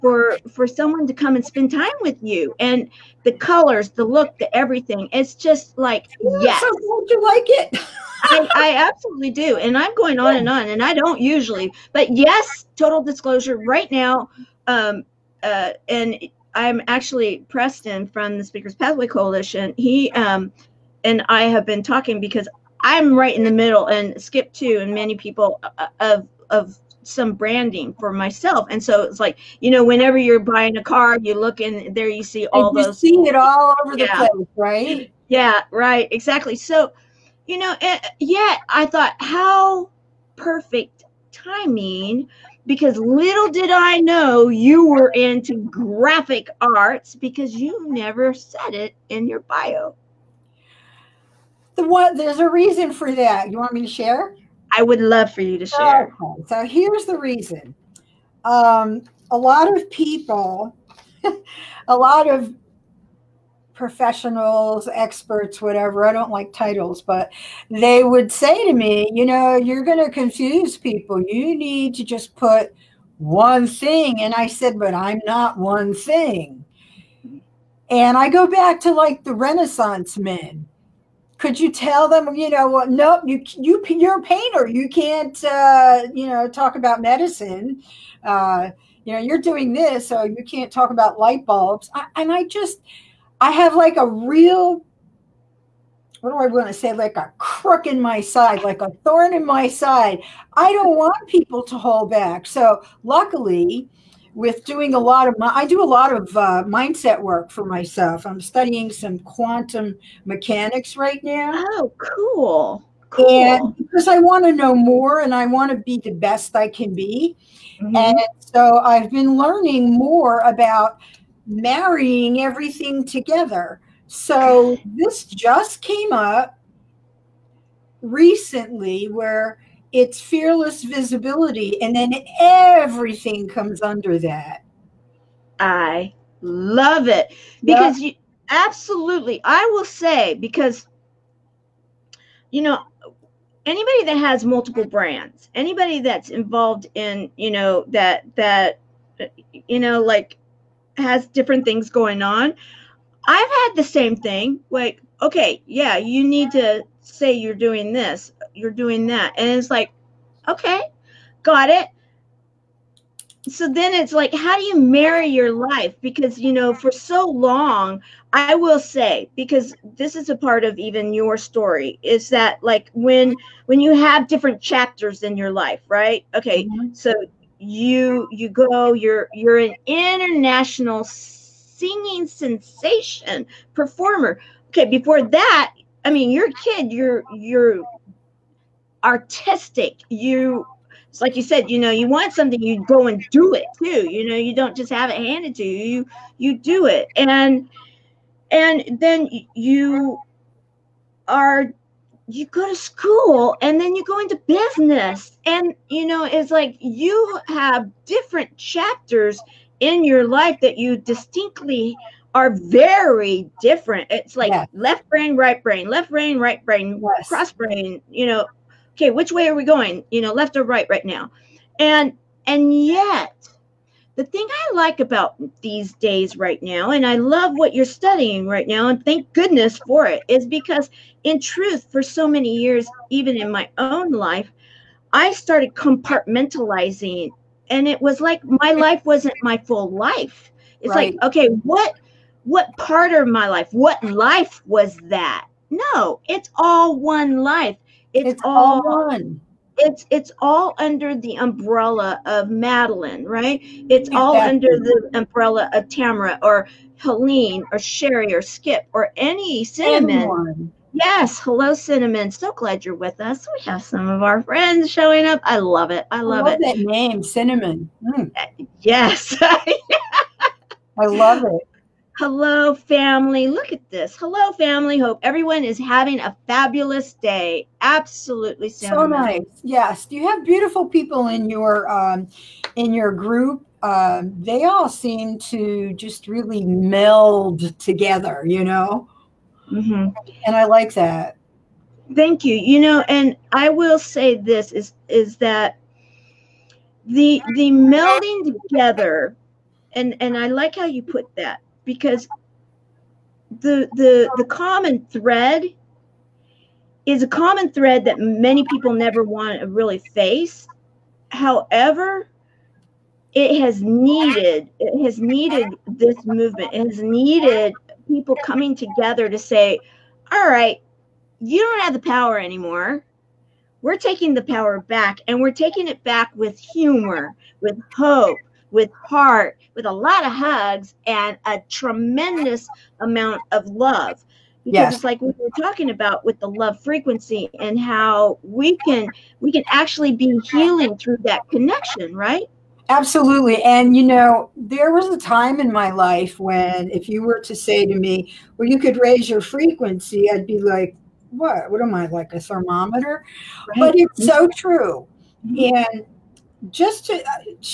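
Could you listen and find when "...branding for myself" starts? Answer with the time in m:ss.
0:27.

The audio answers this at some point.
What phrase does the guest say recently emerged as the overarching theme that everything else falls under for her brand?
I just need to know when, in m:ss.
2:10.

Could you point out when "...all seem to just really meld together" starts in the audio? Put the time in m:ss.
4:44.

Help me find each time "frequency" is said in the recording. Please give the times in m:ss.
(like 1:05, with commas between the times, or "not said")
5:36, 5:49.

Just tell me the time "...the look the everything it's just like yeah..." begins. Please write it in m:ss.
0:03.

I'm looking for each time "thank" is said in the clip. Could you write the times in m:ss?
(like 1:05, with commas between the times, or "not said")
3:49, 4:52.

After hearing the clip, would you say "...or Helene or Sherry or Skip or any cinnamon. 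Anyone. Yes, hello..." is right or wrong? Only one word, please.
right.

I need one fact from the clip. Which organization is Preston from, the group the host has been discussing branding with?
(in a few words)
Speakers Pathway Coalition.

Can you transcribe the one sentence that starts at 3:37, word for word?
cross brain you know okay, which way are we going?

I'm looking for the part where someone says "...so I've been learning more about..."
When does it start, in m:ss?
1:58.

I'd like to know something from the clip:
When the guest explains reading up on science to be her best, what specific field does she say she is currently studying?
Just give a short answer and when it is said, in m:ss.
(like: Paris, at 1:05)
quantum mechanics, at 1:49.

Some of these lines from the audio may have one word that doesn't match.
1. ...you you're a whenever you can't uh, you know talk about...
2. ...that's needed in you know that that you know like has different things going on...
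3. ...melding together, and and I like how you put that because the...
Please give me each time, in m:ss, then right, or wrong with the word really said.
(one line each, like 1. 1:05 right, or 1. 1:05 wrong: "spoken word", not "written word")
1. 1:23 wrong: "painter", not "whenever"
2. 2:25 wrong: "involved", not "needed"
3. 4:57 right.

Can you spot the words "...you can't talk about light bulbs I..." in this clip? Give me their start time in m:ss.
1:30.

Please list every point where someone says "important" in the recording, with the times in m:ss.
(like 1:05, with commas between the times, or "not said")
not said.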